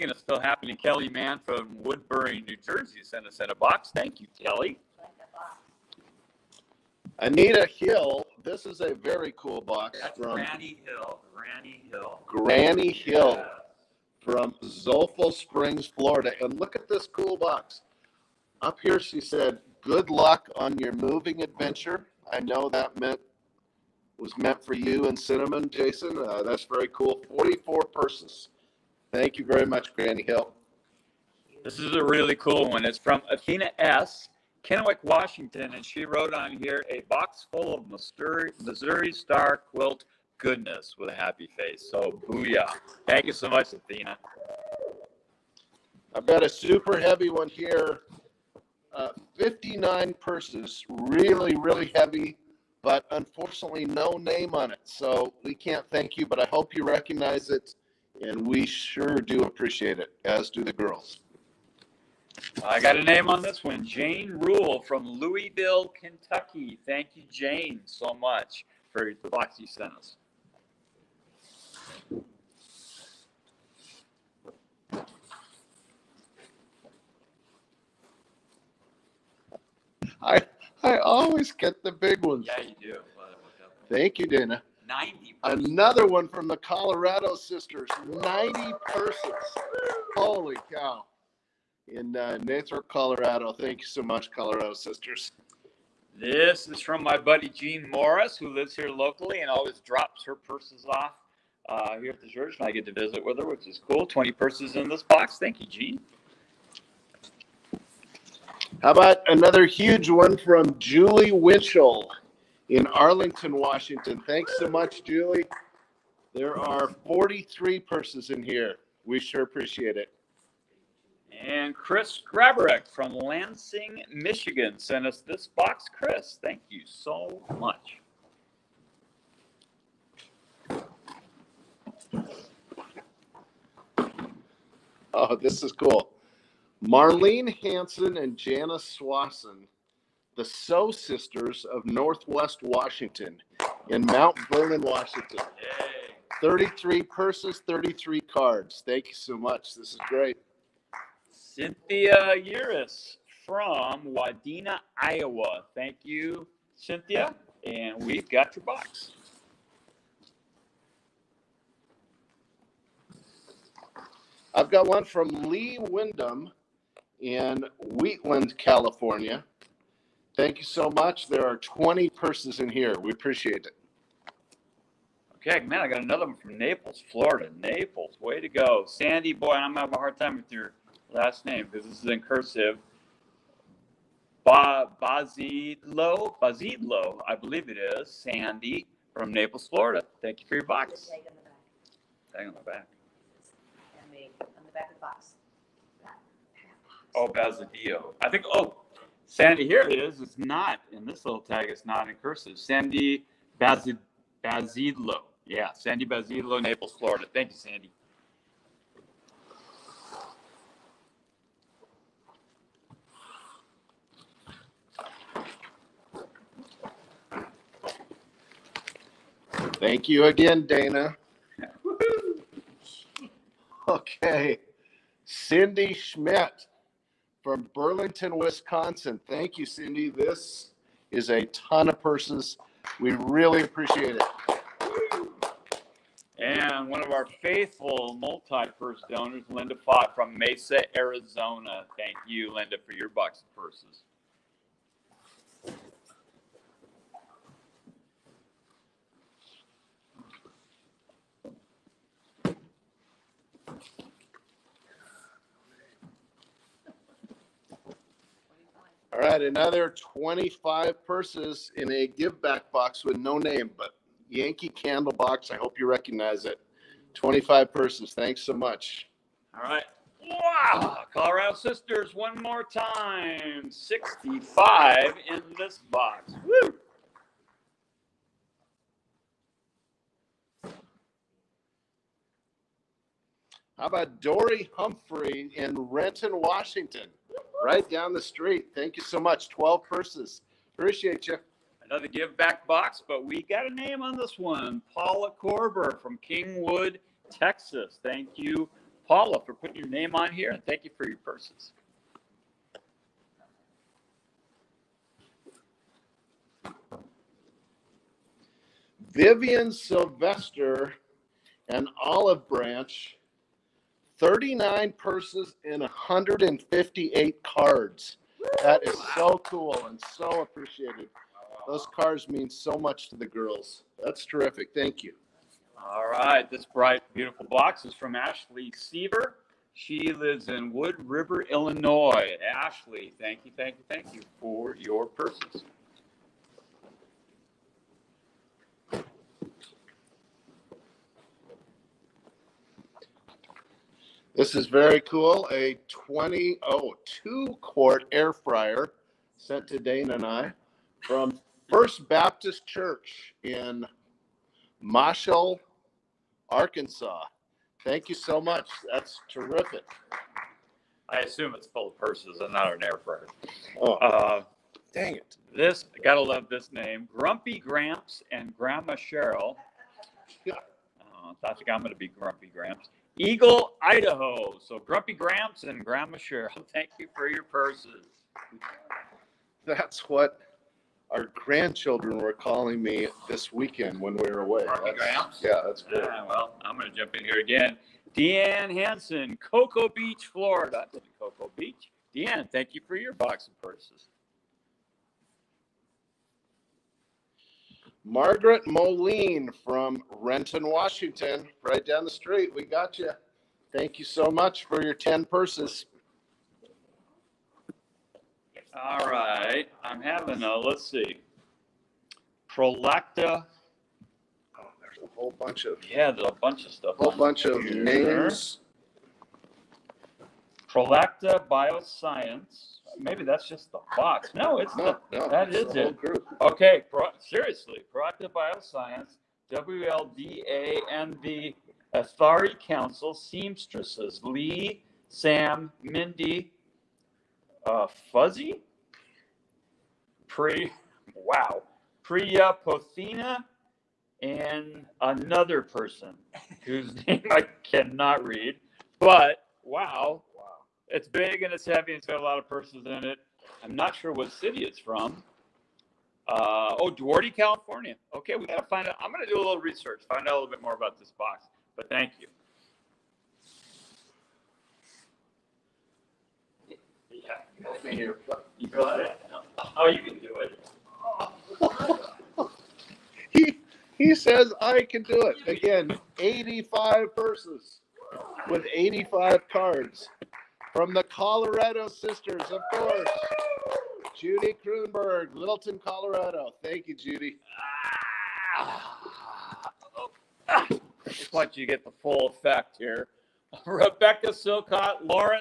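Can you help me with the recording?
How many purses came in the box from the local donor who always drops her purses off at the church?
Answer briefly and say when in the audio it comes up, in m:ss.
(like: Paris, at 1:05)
20, at 1:44.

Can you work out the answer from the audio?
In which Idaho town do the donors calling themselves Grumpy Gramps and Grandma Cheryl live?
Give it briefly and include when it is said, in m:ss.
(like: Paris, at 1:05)
Eagle, at 6:13.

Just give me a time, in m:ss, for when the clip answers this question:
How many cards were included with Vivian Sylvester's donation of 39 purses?
5:15.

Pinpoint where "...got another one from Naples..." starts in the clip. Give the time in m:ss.
2:55.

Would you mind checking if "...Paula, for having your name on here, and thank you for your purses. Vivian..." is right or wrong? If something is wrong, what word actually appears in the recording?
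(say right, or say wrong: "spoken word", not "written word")
wrong: "putting", not "having".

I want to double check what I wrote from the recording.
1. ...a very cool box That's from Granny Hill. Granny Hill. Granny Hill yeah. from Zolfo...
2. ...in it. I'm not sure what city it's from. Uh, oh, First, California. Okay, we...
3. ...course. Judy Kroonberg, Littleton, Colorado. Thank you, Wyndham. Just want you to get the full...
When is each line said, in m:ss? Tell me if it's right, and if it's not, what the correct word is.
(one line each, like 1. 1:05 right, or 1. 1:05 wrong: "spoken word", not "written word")
1. 0:08 right
2. 7:32 wrong: "Duarte", not "First"
3. 8:02 wrong: "Judy", not "Wyndham".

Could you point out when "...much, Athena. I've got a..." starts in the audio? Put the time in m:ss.
0:43.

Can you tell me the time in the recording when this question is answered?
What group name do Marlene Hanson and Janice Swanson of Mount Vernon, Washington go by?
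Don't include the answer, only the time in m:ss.
2:20.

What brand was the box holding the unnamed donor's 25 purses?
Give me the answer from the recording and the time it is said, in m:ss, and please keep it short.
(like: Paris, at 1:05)
Yankee Candle, at 4:24.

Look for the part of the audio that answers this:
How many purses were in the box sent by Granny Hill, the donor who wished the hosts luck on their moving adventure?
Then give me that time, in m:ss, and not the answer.
0:27.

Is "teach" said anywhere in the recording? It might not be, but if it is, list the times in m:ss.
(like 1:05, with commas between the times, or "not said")
not said.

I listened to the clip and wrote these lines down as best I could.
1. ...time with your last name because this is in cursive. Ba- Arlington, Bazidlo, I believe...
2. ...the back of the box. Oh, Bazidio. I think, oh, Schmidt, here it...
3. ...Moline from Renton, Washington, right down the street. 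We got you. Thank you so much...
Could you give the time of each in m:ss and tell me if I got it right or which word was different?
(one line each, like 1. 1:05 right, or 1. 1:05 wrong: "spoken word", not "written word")
1. 3:00 wrong: "Bazidlo", not "Arlington"
2. 3:14 wrong: "Sandy", not "Schmidt"
3. 6:38 right.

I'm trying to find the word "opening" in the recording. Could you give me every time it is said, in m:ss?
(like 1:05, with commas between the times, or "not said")
not said.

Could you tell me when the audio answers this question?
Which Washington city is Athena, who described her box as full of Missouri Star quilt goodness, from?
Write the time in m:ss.
0:34.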